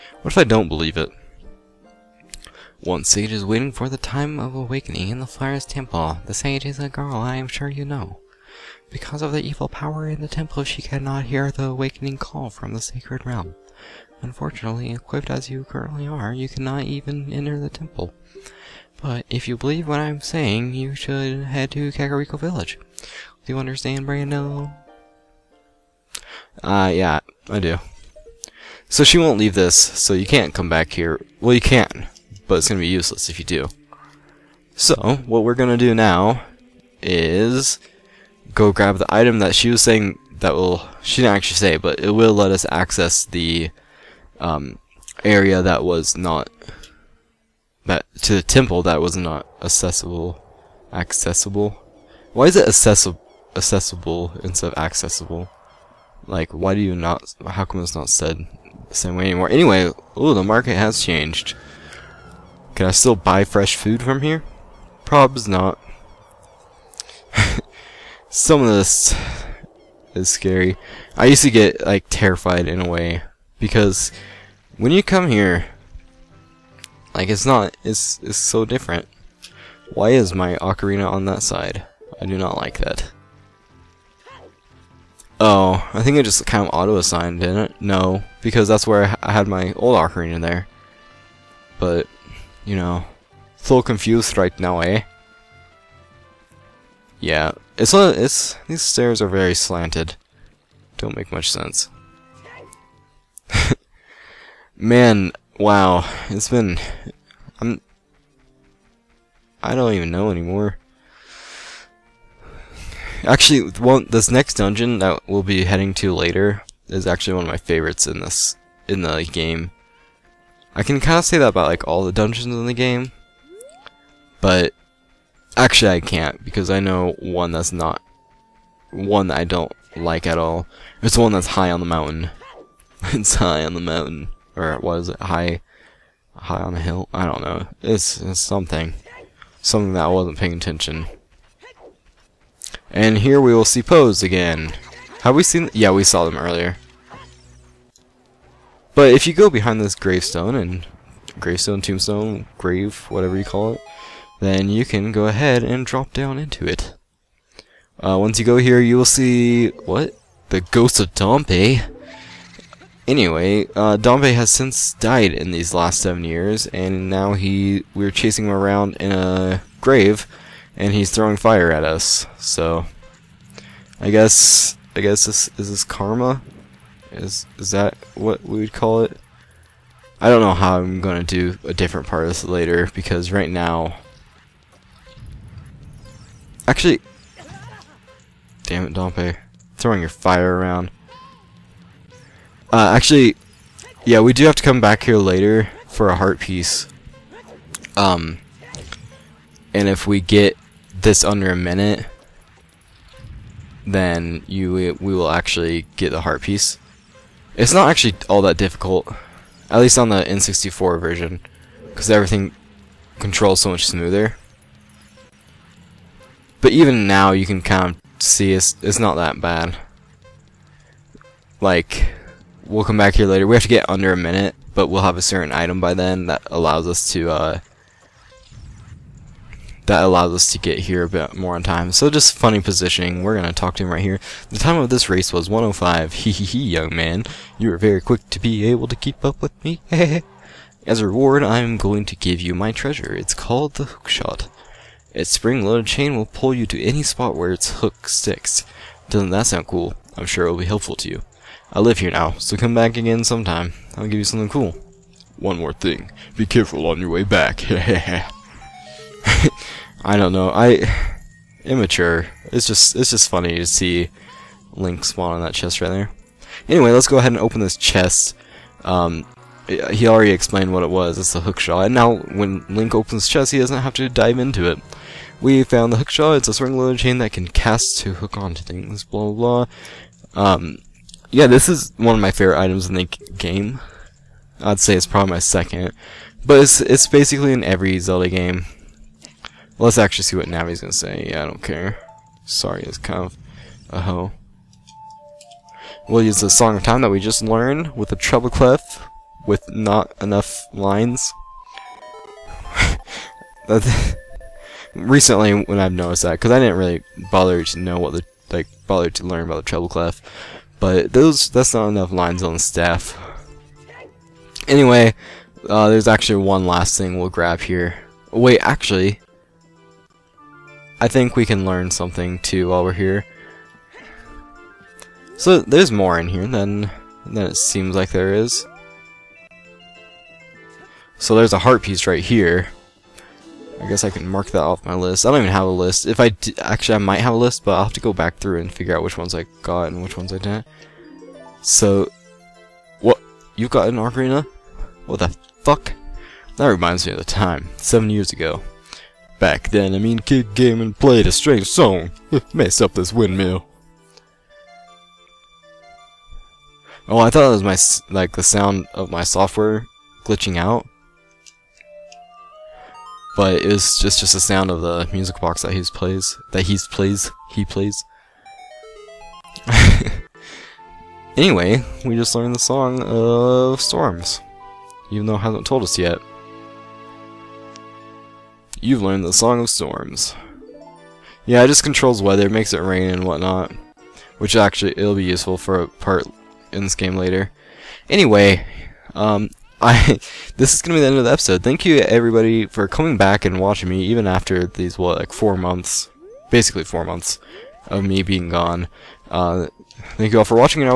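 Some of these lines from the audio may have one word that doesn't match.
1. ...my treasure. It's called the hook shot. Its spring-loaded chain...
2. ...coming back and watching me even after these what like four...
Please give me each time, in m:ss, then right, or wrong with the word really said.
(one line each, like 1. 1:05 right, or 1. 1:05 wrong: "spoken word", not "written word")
1. 4:02 right
2. 6:32 right.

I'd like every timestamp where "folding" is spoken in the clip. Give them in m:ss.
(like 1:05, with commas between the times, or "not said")
not said.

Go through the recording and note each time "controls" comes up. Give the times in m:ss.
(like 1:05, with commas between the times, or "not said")
3:33, 6:21.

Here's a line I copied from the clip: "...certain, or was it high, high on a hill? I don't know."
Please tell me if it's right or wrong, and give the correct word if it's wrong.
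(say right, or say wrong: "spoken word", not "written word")
wrong: "mountain", not "certain".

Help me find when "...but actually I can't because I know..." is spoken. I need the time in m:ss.
2:04.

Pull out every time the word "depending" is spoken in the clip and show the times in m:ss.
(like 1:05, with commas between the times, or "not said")
not said.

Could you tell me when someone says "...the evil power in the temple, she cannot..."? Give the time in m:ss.
0:09.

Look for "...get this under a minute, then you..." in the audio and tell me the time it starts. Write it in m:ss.
3:20.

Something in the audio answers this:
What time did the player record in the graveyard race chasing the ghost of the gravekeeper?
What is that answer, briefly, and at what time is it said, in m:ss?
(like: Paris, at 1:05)
105, at 3:55.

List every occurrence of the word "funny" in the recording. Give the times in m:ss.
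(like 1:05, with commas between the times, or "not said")
3:52, 4:23.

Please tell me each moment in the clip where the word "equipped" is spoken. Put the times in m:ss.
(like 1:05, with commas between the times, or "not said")
0:14.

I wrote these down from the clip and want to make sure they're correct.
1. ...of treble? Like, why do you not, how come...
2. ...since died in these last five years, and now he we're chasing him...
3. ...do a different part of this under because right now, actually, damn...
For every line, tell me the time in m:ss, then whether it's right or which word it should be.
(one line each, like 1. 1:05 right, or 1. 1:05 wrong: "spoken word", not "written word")
1. 0:54 wrong: "accessible", not "treble"
2. 2:44 wrong: "seven", not "five"
3. 3:01 wrong: "later", not "under".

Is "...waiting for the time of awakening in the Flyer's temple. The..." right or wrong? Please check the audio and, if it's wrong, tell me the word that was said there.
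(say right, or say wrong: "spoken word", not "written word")
right.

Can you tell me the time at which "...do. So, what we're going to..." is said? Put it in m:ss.
0:33.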